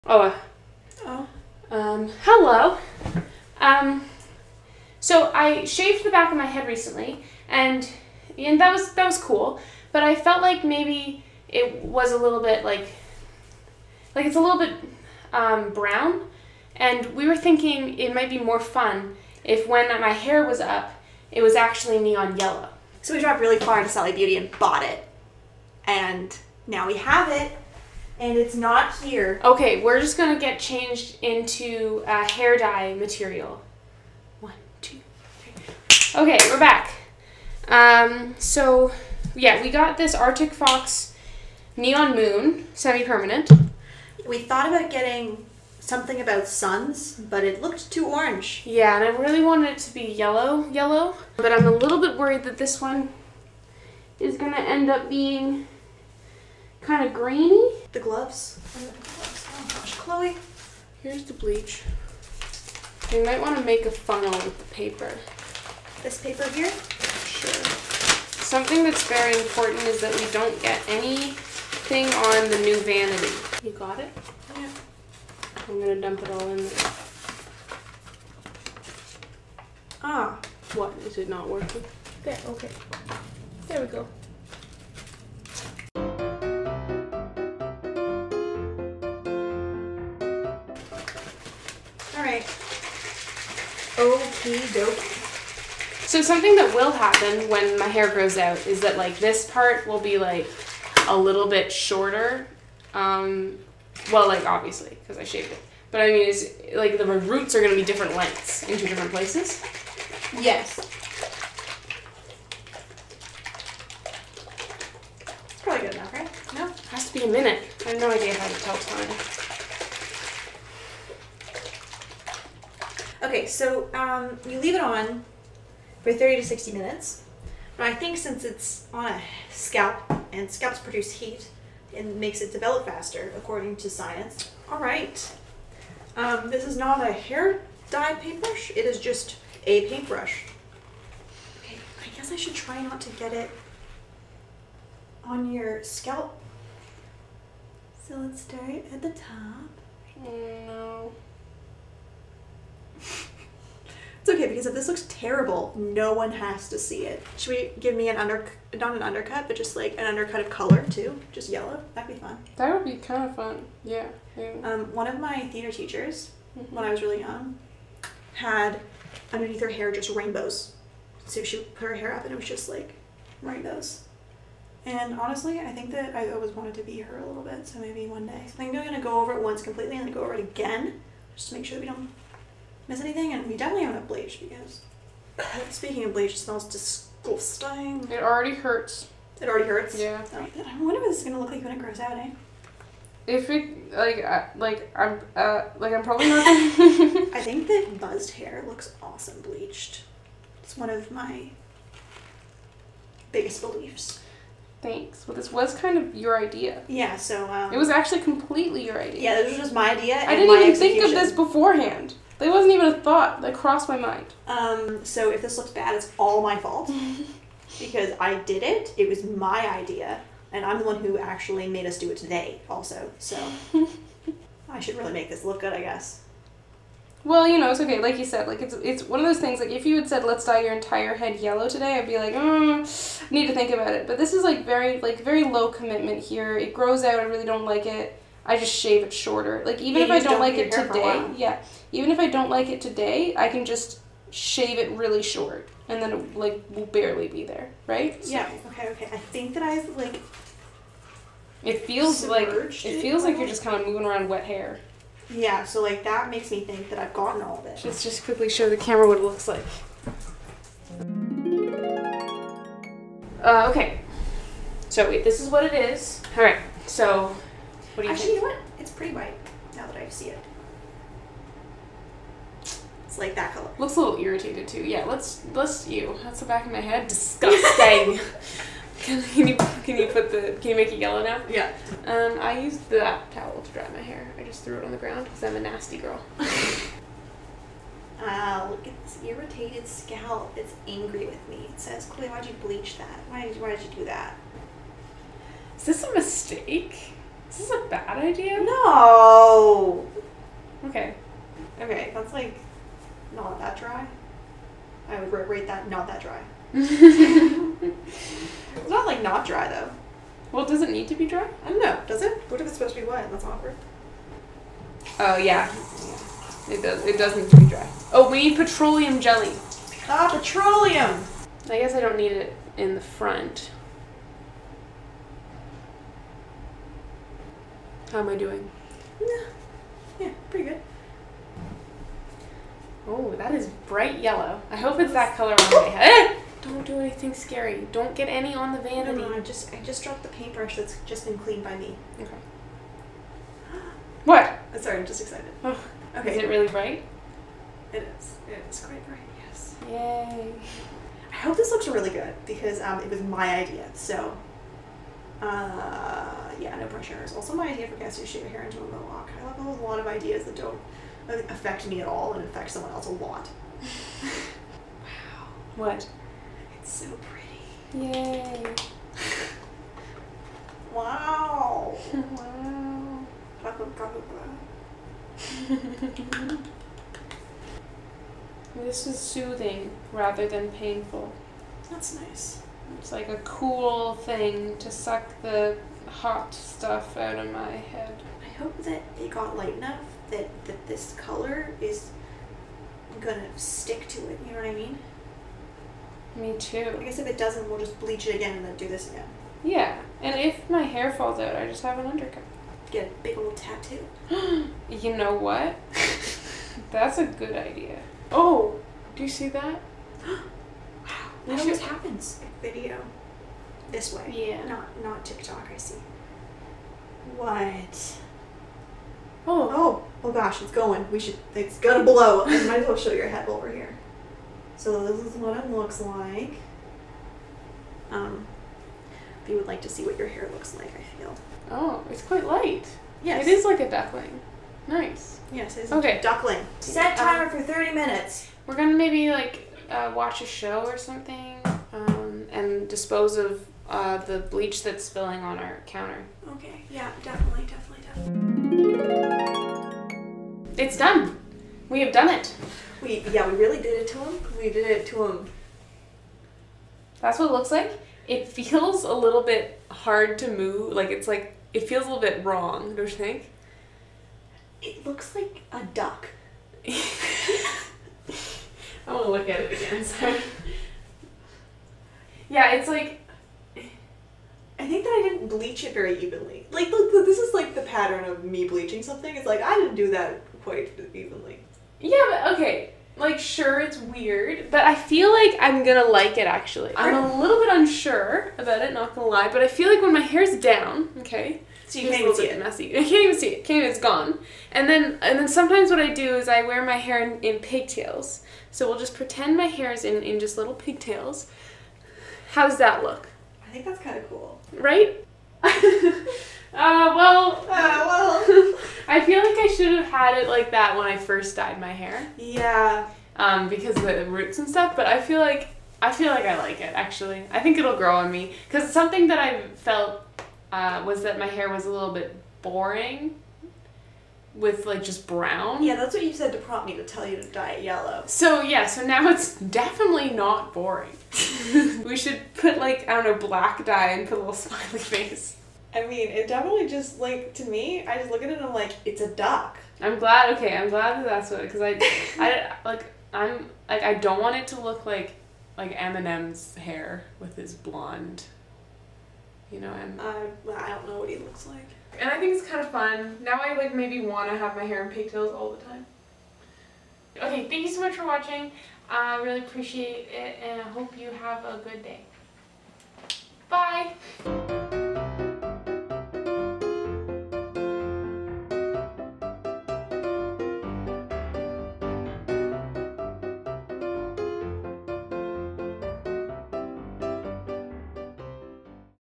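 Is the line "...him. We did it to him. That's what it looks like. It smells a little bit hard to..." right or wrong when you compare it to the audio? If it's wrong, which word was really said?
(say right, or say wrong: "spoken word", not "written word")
wrong: "feels", not "smells".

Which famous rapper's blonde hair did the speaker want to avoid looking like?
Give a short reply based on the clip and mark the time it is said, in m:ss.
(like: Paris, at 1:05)
Eminem, at 9:05.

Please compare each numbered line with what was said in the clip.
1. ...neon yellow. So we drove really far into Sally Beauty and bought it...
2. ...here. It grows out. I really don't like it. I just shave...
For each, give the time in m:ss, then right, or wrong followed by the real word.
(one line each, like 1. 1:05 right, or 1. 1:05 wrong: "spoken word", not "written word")
1. 0:21 right
2. 3:56 right.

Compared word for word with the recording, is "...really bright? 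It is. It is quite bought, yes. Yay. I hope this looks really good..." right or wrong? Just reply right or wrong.
wrong.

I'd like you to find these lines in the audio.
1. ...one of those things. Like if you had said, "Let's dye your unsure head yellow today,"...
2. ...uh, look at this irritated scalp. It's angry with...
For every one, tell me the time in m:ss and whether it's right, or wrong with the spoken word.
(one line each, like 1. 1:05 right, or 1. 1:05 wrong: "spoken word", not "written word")
1. 3:49 wrong: "entire", not "unsure"
2. 4:48 right.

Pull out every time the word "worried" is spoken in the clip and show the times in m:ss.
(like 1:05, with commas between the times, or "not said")
0:52.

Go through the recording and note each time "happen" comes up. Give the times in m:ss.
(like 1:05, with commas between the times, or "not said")
1:36, 6:51.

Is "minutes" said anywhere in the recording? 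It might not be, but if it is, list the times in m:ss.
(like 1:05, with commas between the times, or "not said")
1:57, 2:06, 7:17.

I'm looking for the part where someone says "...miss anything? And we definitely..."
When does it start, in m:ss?
3:02.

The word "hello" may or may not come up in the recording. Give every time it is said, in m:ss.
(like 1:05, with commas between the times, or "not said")
0:02.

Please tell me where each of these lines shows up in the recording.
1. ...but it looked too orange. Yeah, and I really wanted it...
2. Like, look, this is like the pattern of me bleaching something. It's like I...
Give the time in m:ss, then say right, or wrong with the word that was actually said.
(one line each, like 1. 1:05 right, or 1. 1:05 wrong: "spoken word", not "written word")
1. 0:47 right
2. 7:56 right.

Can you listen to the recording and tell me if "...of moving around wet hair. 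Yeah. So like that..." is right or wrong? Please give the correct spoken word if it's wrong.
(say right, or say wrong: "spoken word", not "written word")
right.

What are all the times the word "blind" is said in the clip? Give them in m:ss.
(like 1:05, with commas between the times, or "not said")
not said.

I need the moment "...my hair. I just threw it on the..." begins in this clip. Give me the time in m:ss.
4:43.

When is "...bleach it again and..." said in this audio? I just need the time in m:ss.
6:37.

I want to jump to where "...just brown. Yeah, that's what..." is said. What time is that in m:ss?
8:45.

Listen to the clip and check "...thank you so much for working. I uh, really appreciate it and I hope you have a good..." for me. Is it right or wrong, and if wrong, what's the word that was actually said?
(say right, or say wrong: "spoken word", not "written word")
wrong: "watching", not "working".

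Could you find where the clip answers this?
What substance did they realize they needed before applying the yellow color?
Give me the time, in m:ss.
5:18.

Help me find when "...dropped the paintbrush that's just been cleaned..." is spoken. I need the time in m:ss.
5:40.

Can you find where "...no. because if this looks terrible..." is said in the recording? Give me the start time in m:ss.
2:30.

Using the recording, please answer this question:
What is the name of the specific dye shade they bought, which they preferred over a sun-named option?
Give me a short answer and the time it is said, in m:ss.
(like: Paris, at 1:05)
Neon Moon, at 0:41.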